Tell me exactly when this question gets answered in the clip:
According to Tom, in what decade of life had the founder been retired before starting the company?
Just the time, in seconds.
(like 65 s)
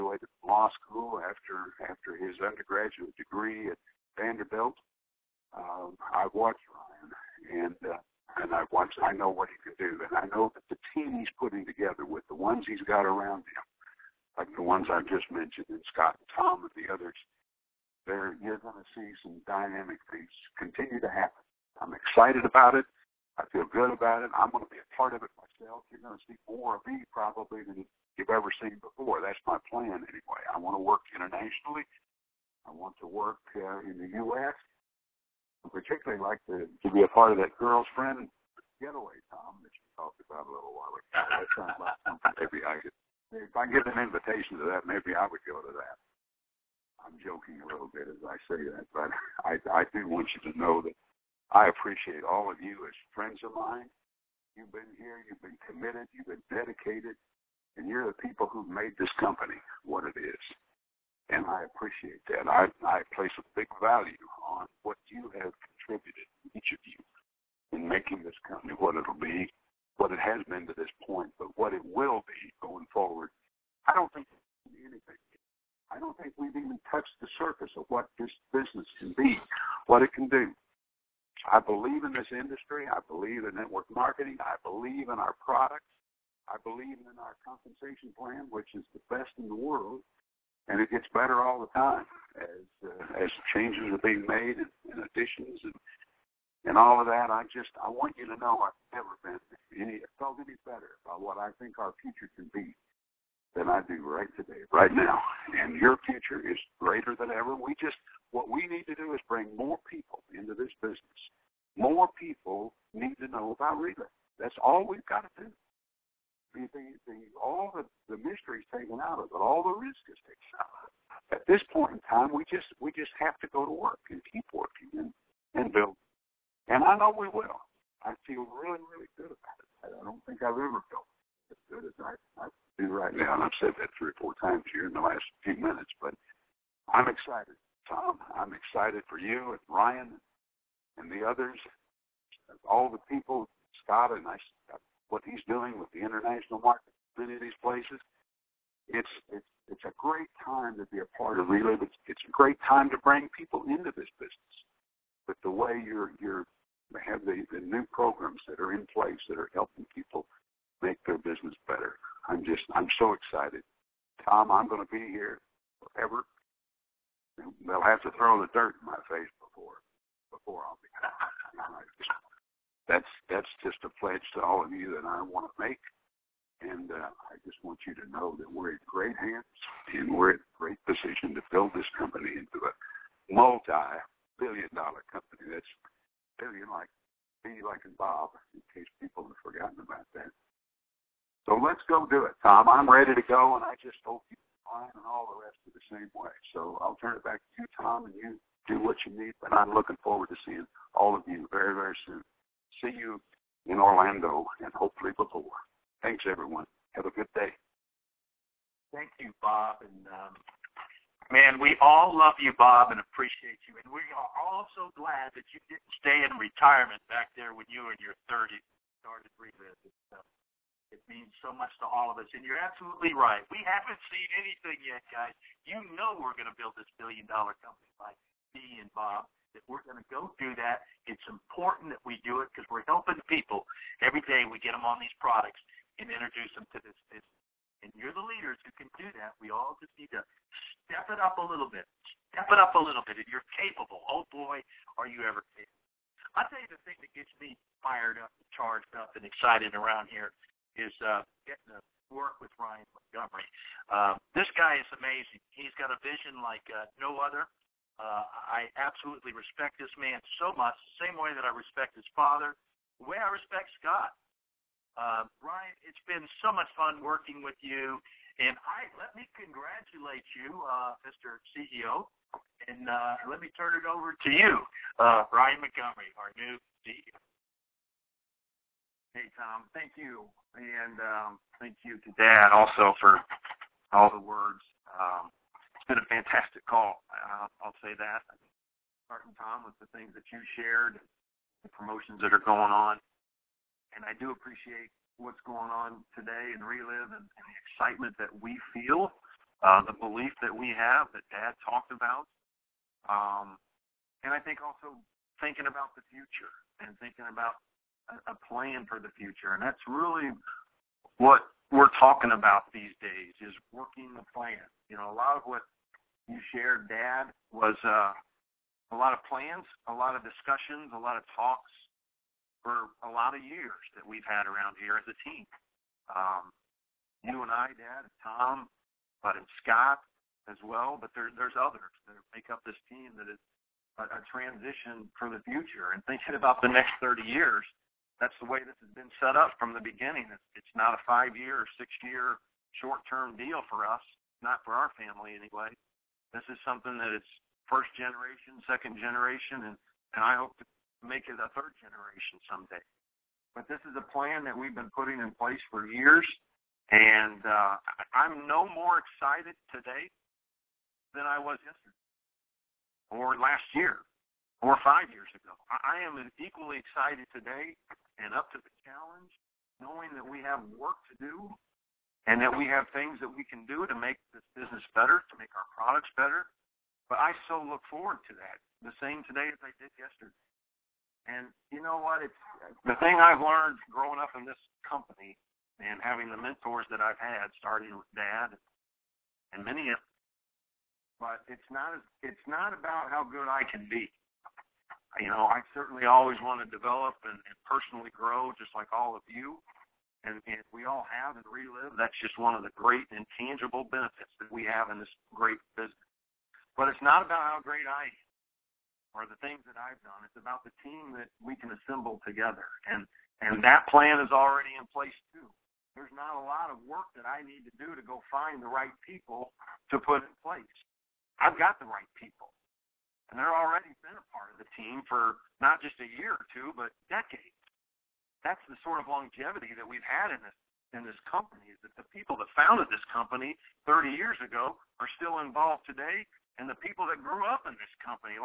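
218 s.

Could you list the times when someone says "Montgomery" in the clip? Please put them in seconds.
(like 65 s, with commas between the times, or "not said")
252 s, 275 s.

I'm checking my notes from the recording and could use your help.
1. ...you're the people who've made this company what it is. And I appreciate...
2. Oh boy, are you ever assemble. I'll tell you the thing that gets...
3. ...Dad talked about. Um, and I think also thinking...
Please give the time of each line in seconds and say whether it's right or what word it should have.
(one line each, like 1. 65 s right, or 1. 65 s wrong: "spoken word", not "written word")
1. 57 s right
2. 244 s wrong: "capable", not "assemble"
3. 301 s right.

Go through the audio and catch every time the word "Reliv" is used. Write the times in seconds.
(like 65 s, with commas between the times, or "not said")
113 s, 151 s, 296 s, 401 s.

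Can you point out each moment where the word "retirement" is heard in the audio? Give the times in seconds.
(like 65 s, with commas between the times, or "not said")
216 s.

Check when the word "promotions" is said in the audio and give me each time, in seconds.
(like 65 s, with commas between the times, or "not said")
291 s.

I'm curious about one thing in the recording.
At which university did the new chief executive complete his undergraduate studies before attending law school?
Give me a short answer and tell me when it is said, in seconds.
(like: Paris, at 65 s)
Vanderbilt, at 4 s.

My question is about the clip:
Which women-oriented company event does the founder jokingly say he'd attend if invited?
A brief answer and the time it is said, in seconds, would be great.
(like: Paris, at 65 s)
girlfriend getaway, at 37 s.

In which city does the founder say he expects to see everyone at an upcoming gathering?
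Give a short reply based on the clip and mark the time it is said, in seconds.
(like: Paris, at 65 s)
Orlando, at 203 s.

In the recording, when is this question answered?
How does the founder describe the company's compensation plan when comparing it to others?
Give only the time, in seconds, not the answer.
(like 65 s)
88 s.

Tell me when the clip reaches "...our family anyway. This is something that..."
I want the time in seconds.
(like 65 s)
344 s.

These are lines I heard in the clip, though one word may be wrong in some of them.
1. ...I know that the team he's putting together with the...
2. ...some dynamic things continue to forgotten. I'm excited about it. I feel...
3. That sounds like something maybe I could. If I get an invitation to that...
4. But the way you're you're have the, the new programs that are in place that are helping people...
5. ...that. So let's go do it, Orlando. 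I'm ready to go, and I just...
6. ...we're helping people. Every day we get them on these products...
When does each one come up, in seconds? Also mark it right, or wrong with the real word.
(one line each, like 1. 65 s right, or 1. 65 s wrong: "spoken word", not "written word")
1. 10 s right
2. 19 s wrong: "happen", not "forgotten"
3. 41 s right
4. 155 s right
5. 190 s wrong: "Tom", not "Orlando"
6. 232 s right.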